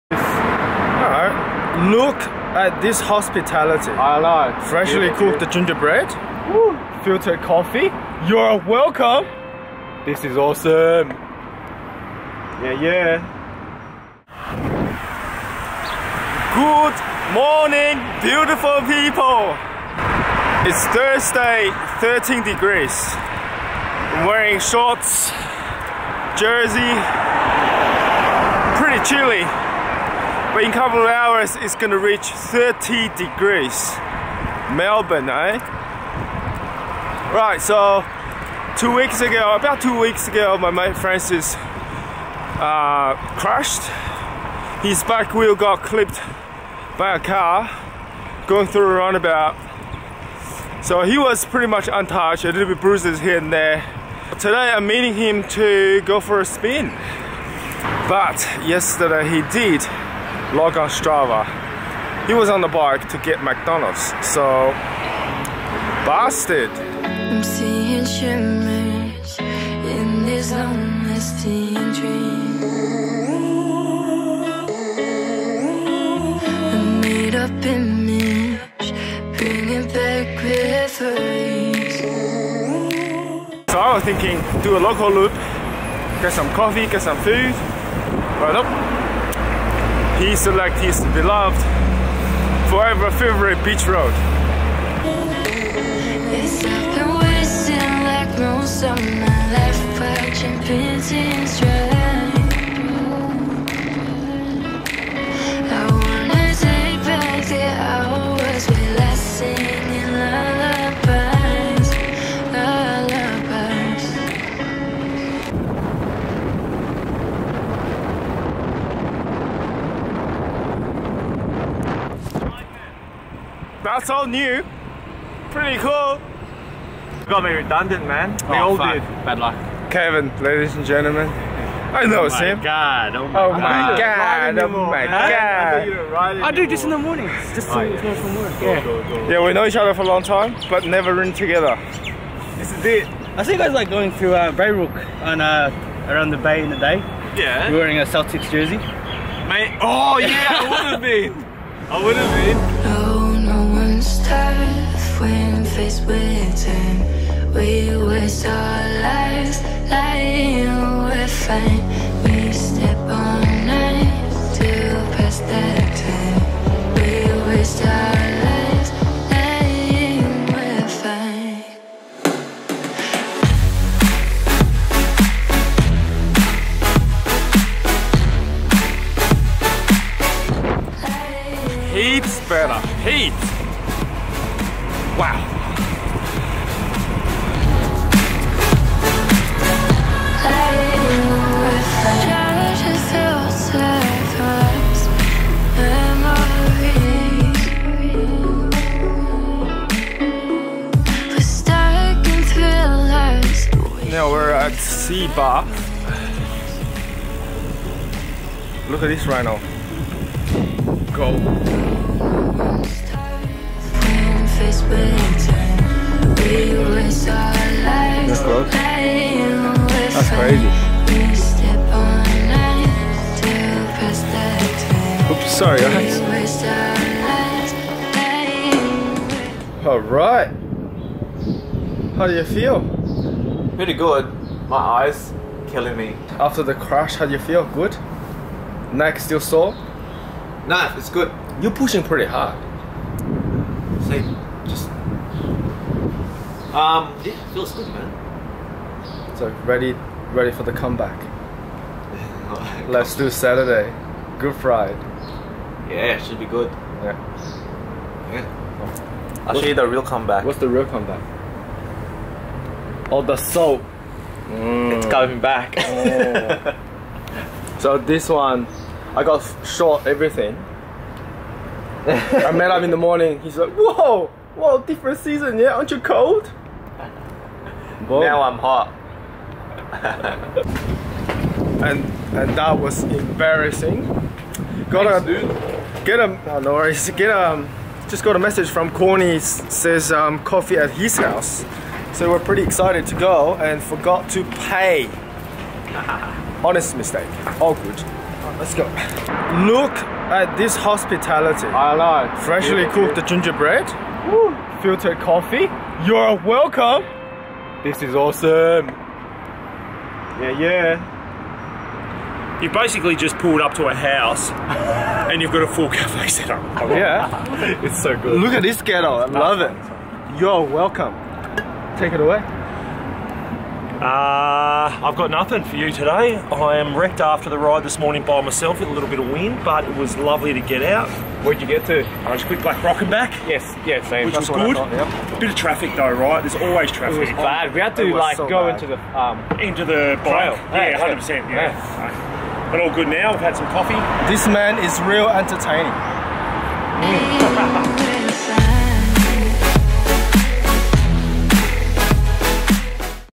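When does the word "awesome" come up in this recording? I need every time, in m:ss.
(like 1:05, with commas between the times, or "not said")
0:10, 5:08.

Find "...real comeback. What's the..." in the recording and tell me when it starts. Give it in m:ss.
4:19.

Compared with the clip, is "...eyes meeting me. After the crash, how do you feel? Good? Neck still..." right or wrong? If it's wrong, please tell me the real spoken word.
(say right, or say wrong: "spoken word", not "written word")
wrong: "killing", not "meeting".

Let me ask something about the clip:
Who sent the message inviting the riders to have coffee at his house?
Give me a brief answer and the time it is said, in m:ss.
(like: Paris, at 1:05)
Corny, at 4:48.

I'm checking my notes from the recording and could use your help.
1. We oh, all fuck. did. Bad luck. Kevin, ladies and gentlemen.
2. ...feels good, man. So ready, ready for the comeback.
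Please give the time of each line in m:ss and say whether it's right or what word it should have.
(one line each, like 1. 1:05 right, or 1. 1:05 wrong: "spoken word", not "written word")
1. 2:08 right
2. 4:07 right.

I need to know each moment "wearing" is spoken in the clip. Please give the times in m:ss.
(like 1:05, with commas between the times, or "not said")
0:24, 2:27.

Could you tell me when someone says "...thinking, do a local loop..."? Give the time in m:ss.
1:24.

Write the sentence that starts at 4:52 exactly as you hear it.
So we're pretty excited to go and forgot to pay.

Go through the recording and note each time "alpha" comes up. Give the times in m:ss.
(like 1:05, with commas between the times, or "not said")
not said.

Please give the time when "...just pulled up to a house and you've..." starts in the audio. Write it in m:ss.
5:13.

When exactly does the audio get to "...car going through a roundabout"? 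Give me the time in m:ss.
0:47.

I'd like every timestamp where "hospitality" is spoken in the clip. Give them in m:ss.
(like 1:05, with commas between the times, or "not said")
0:02, 5:00.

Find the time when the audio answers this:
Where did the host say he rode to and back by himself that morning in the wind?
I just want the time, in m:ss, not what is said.
5:32.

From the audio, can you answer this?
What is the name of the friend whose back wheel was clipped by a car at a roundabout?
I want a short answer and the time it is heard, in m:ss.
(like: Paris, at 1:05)
Francis, at 0:40.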